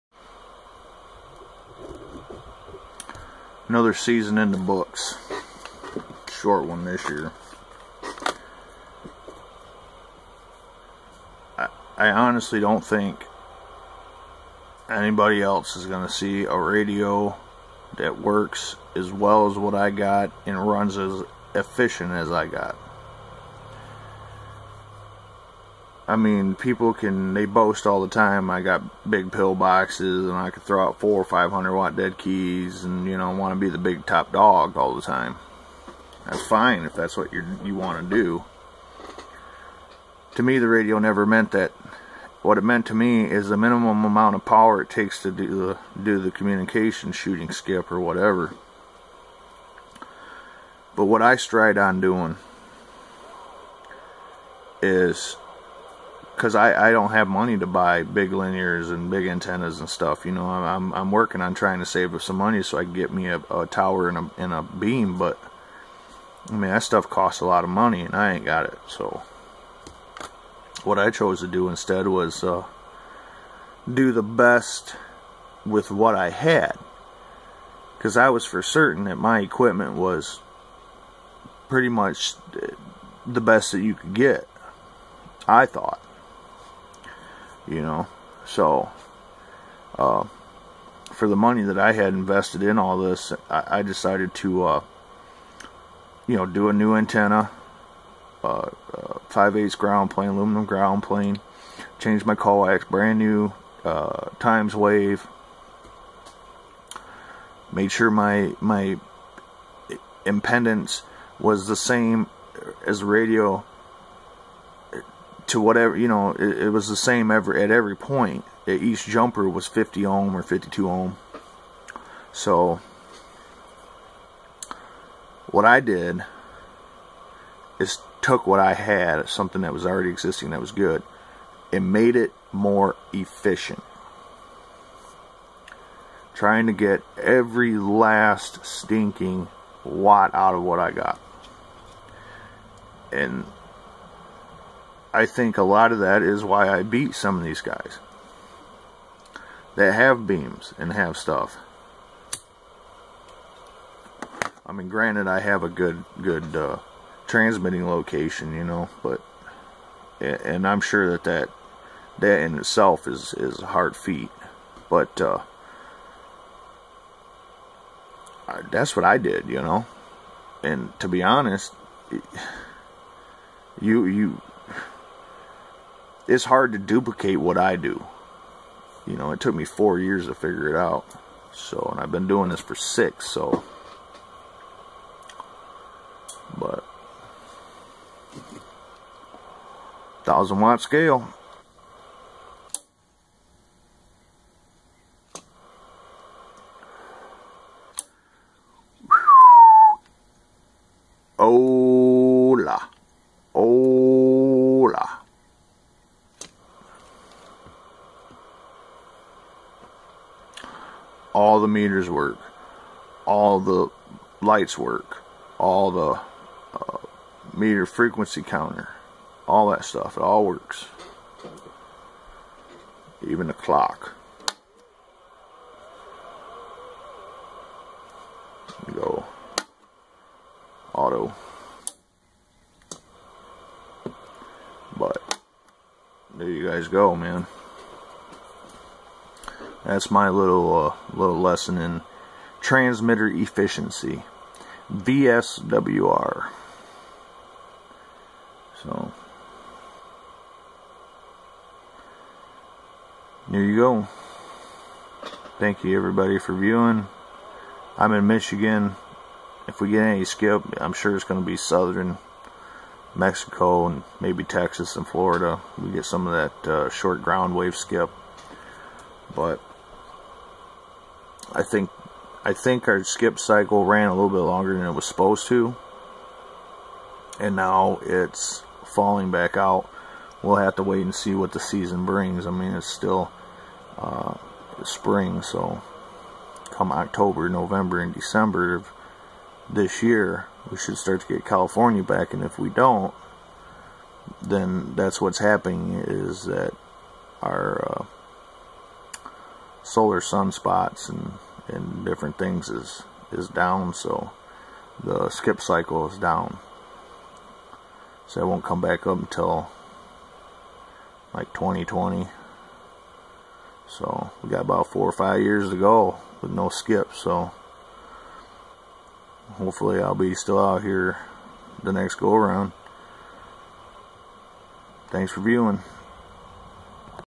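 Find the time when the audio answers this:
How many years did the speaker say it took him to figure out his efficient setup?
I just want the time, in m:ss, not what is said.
2:59.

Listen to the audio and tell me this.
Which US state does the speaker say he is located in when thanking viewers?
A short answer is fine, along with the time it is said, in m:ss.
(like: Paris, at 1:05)
Michigan, at 4:18.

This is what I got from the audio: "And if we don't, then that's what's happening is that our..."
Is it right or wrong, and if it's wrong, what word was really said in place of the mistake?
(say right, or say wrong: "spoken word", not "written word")
right.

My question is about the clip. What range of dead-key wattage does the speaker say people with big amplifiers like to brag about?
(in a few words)
400 or 500 watts.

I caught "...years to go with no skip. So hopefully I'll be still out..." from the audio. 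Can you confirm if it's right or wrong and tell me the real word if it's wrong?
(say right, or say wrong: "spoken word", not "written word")
right.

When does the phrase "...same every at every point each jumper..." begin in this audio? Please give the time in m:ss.
1:56.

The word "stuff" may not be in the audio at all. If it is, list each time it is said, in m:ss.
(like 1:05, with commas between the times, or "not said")
0:59, 1:06, 2:31, 3:39.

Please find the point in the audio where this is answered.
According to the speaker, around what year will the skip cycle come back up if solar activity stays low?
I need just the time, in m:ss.
5:11.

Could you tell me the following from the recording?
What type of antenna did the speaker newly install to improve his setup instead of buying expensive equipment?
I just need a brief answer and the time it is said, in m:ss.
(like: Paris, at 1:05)
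5/8 ground plane, at 1:39.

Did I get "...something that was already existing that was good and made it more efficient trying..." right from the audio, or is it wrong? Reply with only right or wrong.
right.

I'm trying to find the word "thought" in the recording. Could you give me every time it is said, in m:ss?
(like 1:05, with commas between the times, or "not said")
1:25.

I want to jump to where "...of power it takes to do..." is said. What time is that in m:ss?
0:44.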